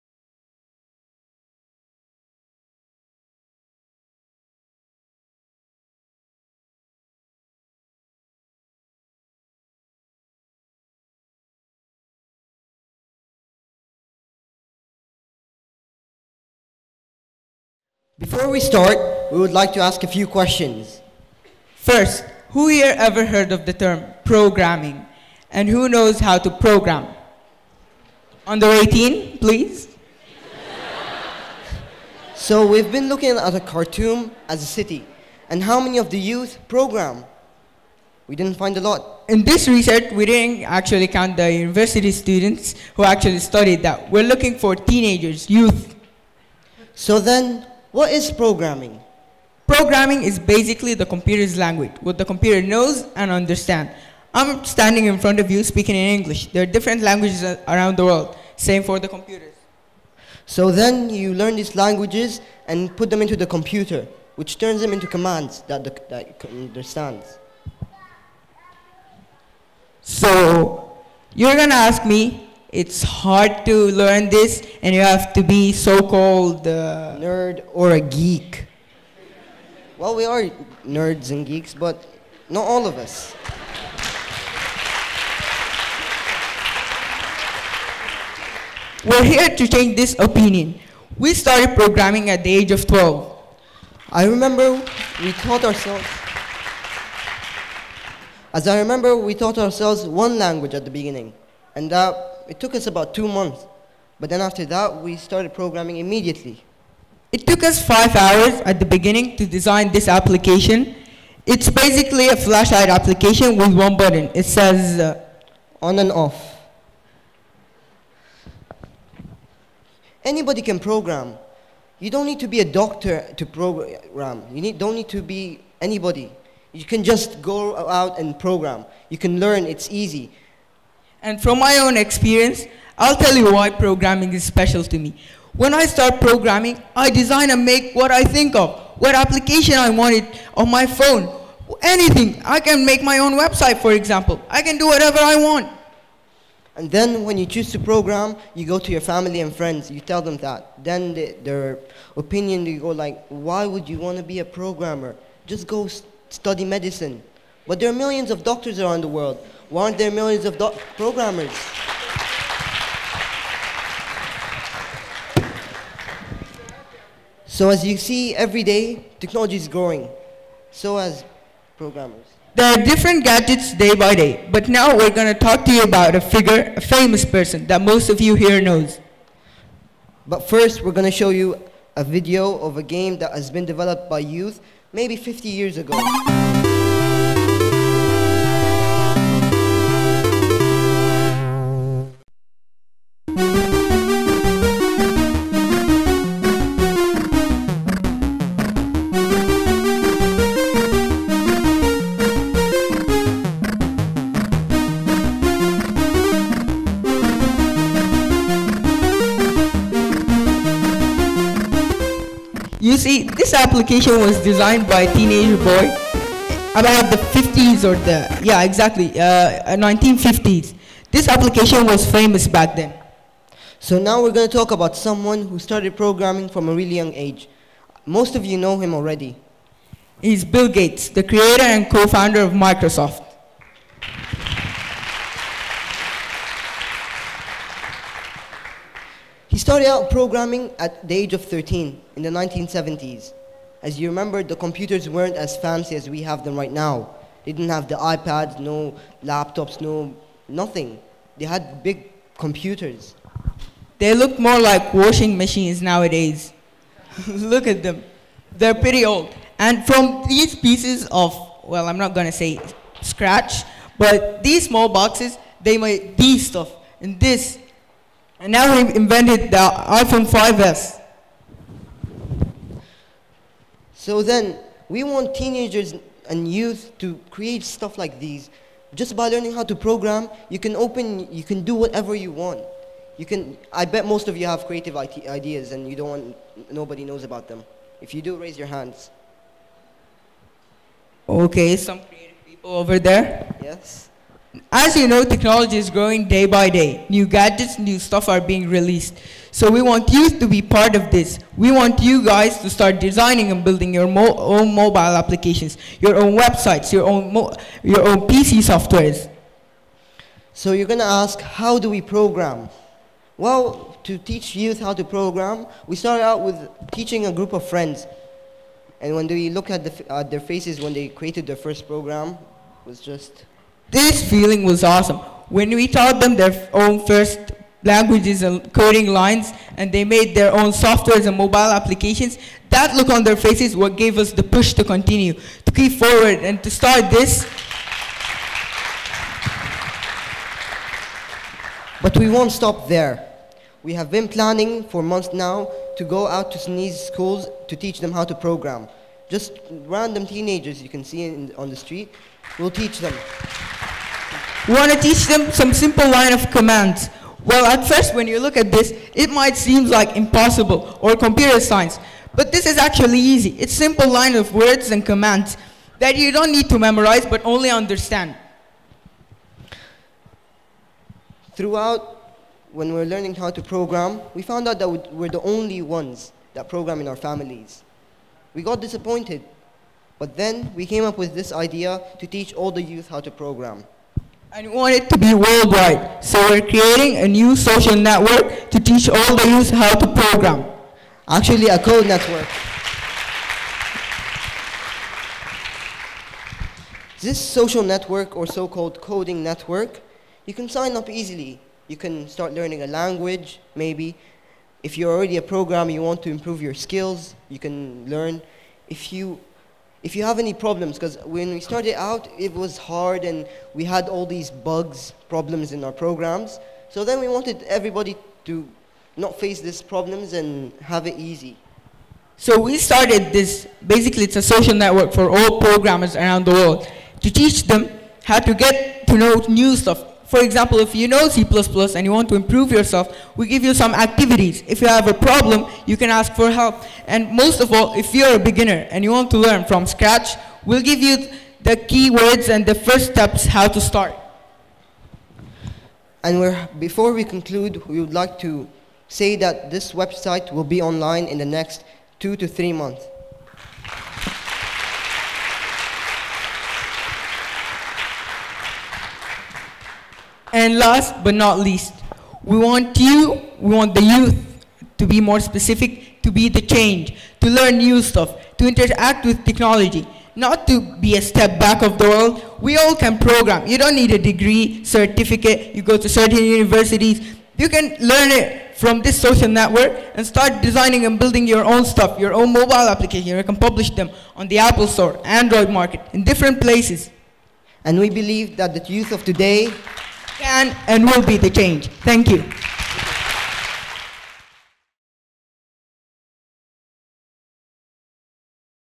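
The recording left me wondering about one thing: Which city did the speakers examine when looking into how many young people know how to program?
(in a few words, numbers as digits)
Khartoum.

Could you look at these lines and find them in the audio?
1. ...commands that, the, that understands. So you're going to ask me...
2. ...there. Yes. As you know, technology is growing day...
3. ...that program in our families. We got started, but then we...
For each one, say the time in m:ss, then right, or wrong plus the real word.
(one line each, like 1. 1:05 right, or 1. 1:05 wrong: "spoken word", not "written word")
1. 1:05 right
2. 4:52 right
3. 6:16 wrong: "disappointed", not "started".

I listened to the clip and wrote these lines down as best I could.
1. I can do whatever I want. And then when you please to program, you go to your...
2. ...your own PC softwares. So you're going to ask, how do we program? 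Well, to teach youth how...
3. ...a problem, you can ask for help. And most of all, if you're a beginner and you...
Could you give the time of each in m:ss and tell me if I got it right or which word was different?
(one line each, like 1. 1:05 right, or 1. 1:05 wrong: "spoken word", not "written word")
1. 2:24 wrong: "choose", not "please"
2. 5:07 right
3. 7:15 right.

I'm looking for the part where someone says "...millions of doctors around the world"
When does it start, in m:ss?
2:37.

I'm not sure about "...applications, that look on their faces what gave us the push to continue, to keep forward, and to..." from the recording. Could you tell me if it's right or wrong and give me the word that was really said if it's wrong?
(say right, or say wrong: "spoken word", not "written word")
right.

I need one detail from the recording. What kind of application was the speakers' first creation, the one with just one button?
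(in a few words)
flashlight application.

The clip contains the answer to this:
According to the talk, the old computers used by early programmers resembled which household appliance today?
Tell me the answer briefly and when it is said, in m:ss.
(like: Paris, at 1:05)
washing machines, at 4:14.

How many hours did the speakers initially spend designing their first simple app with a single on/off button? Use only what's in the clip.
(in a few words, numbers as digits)
5.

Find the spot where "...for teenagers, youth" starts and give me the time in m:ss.
0:44.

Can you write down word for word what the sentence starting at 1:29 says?
We're here to change this opinion.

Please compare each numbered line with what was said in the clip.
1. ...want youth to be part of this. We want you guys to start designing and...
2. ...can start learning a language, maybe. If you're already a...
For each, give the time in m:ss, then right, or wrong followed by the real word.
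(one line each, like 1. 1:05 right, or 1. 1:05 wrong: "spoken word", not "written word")
1. 4:59 right
2. 6:41 right.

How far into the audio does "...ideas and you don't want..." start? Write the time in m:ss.
4:44.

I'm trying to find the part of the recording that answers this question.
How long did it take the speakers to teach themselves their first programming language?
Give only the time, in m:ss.
1:43.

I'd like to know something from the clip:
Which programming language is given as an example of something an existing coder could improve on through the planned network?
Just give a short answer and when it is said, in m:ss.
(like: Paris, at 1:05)
C++, at 7:11.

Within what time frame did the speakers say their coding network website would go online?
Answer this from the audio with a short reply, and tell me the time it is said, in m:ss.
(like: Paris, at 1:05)
2 to 3 months, at 7:32.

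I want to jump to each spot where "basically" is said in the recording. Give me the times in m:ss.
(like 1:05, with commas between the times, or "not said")
0:50, 1:51, 7:03.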